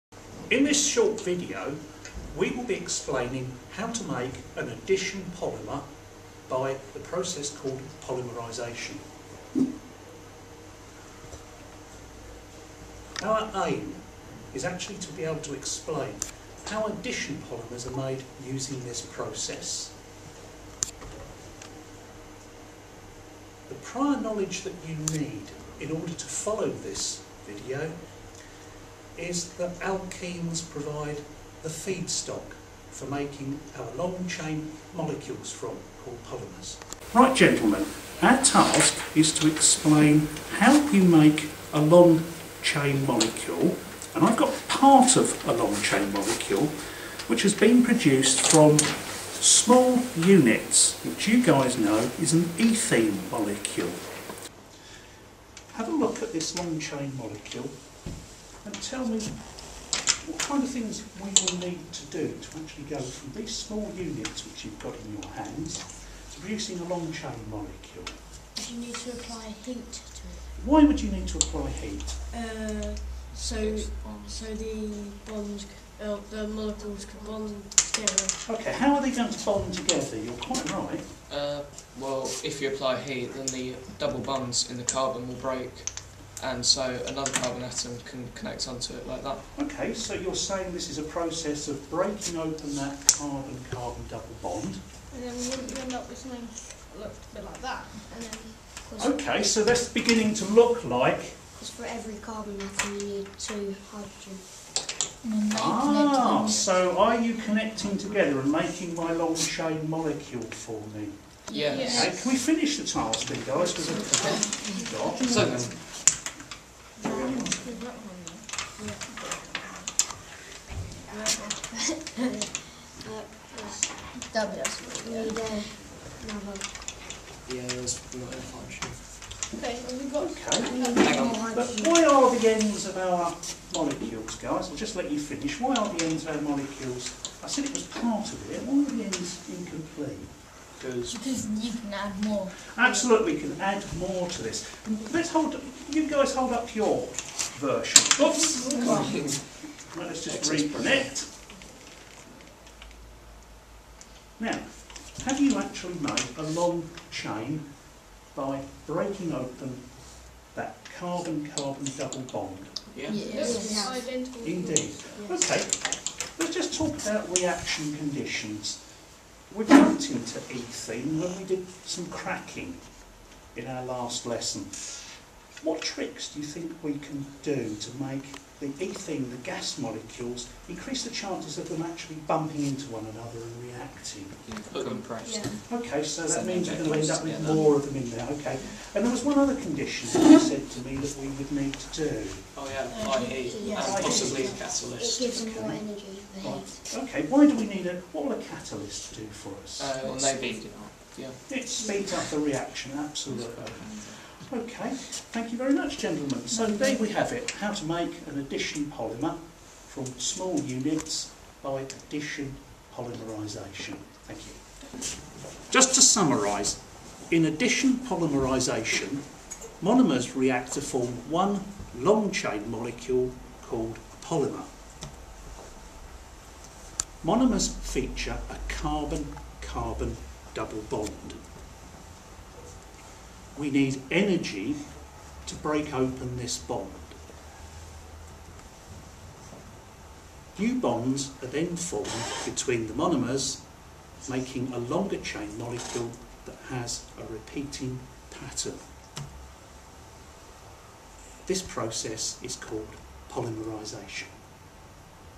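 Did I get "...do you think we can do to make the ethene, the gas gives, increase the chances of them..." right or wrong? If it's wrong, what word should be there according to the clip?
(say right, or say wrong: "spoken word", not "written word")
wrong: "molecules", not "gives".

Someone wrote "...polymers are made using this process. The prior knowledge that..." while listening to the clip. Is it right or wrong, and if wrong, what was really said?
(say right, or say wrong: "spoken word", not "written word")
right.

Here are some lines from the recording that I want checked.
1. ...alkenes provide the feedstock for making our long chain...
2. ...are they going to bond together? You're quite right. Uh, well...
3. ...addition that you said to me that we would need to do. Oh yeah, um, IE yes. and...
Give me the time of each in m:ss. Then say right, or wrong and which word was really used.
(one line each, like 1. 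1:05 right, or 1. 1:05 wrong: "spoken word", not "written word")
1. 0:29 right
2. 1:18 right
3. 3:09 wrong: "condition", not "addition".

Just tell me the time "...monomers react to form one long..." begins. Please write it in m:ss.
3:39.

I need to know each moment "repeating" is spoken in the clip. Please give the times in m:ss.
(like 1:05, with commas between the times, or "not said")
4:07.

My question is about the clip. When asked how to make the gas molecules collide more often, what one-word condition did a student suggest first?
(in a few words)
compressed.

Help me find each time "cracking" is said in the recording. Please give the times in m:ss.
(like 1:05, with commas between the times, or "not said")
2:52.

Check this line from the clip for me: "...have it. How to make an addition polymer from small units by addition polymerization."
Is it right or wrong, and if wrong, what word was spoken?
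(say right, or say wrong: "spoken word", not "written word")
right.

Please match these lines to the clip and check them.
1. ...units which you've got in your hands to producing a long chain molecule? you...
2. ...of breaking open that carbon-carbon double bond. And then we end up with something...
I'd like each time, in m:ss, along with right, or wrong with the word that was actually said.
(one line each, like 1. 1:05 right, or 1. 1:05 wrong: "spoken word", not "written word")
1. 1:03 right
2. 1:31 right.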